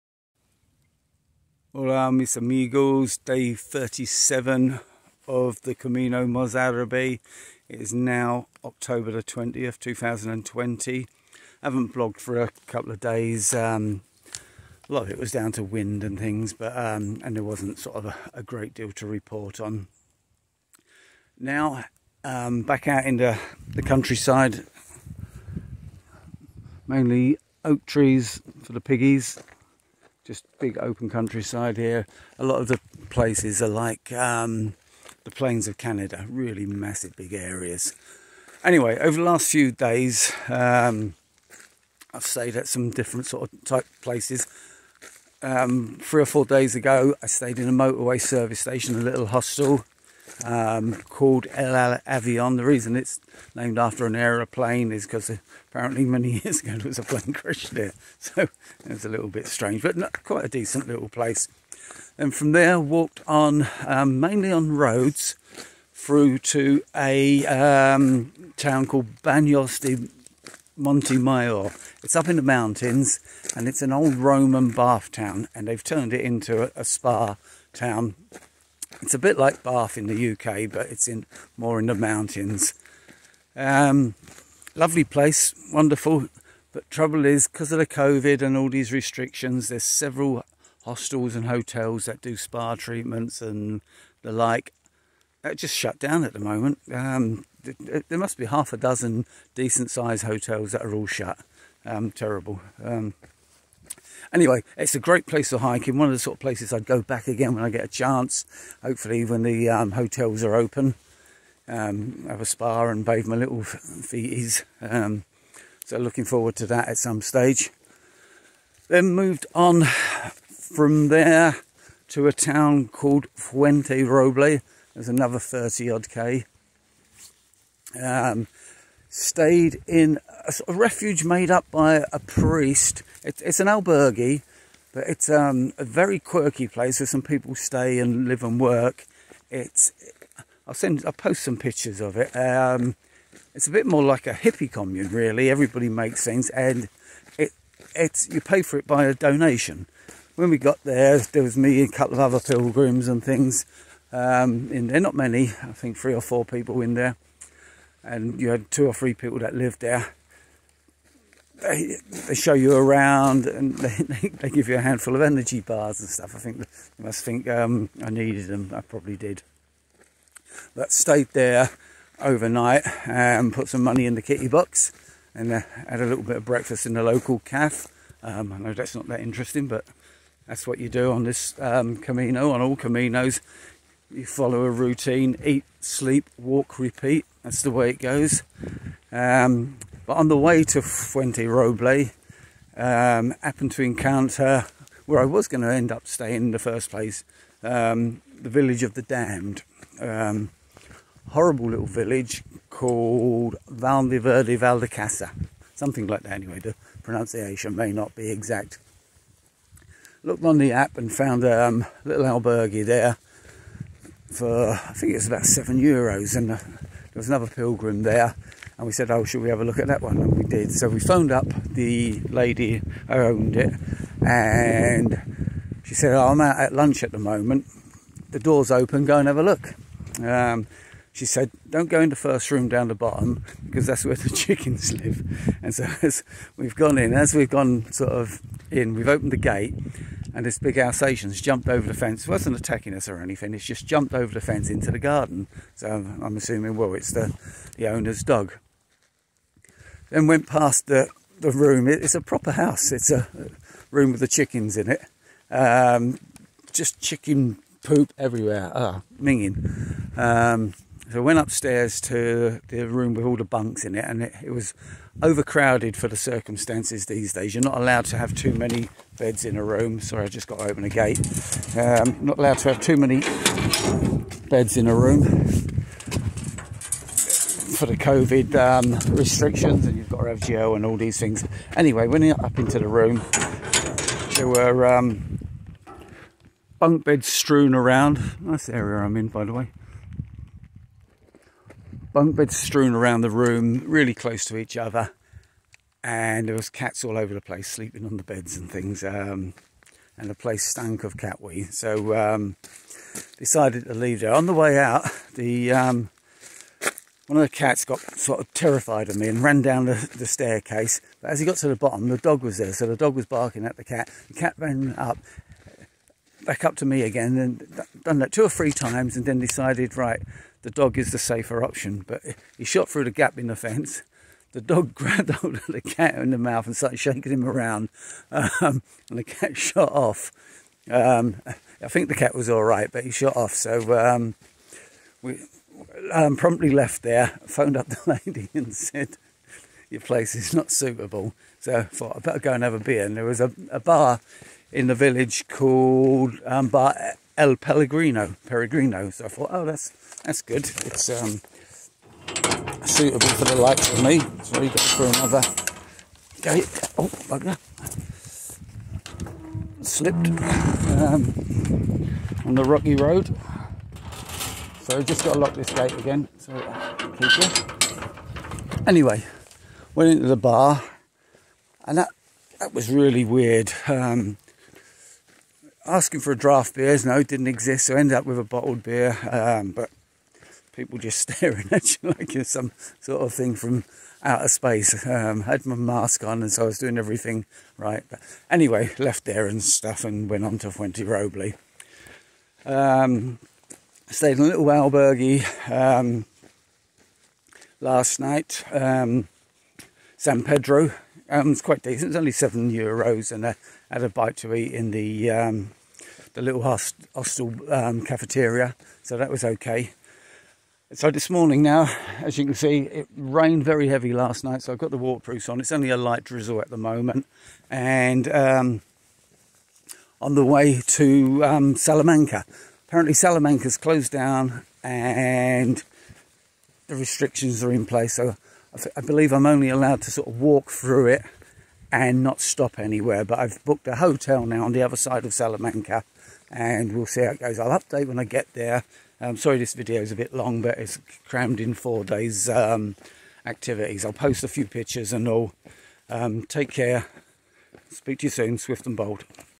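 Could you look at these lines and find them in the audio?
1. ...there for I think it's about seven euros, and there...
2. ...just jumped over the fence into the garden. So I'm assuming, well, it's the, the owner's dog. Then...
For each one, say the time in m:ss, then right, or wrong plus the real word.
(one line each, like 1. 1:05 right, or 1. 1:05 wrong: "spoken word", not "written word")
1. 3:32 right
2. 4:03 right.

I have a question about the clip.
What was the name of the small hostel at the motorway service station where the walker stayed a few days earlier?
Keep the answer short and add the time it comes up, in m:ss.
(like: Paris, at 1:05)
El Avion, at 0:51.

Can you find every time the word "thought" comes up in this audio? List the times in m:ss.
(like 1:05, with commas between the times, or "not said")
5:41, 5:49.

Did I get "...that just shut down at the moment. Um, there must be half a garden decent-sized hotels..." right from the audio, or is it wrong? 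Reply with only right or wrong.
wrong.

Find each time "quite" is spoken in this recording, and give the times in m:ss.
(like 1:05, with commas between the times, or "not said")
1:00, 6:41.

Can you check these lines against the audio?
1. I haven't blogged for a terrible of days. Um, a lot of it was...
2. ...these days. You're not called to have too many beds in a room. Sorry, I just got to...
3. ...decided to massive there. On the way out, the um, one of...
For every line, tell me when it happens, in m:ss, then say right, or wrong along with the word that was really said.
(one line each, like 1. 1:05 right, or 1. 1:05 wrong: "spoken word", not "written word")
1. 0:11 wrong: "couple", not "terrible"
2. 4:27 wrong: "allowed", not "called"
3. 5:03 wrong: "leave", not "massive".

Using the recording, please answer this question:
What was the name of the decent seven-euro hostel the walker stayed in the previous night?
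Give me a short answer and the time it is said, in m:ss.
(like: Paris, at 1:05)
San Pedro, at 6:40.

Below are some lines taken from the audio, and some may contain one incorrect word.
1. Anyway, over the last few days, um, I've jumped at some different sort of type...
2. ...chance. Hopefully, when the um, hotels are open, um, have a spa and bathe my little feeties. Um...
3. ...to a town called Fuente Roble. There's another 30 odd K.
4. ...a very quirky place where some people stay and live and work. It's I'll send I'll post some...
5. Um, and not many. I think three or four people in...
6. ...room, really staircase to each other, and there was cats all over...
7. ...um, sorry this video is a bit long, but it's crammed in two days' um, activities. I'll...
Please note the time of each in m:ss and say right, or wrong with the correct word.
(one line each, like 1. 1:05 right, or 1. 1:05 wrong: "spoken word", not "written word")
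1. 0:38 wrong: "stayed", not "jumped"
2. 1:47 right
3. 2:02 right
4. 2:15 right
5. 2:34 right
6. 4:53 wrong: "close", not "staircase"
7. 7:19 wrong: "four", not "two".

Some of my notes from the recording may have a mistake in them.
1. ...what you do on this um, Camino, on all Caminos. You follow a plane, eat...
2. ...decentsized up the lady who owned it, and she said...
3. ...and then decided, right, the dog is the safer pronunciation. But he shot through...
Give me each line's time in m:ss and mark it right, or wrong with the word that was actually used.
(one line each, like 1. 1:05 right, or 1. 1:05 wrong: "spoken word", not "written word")
1. 3:00 wrong: "routine", not "plane"
2. 3:41 wrong: "phoned", not "decentsized"
3. 5:19 wrong: "option", not "pronunciation".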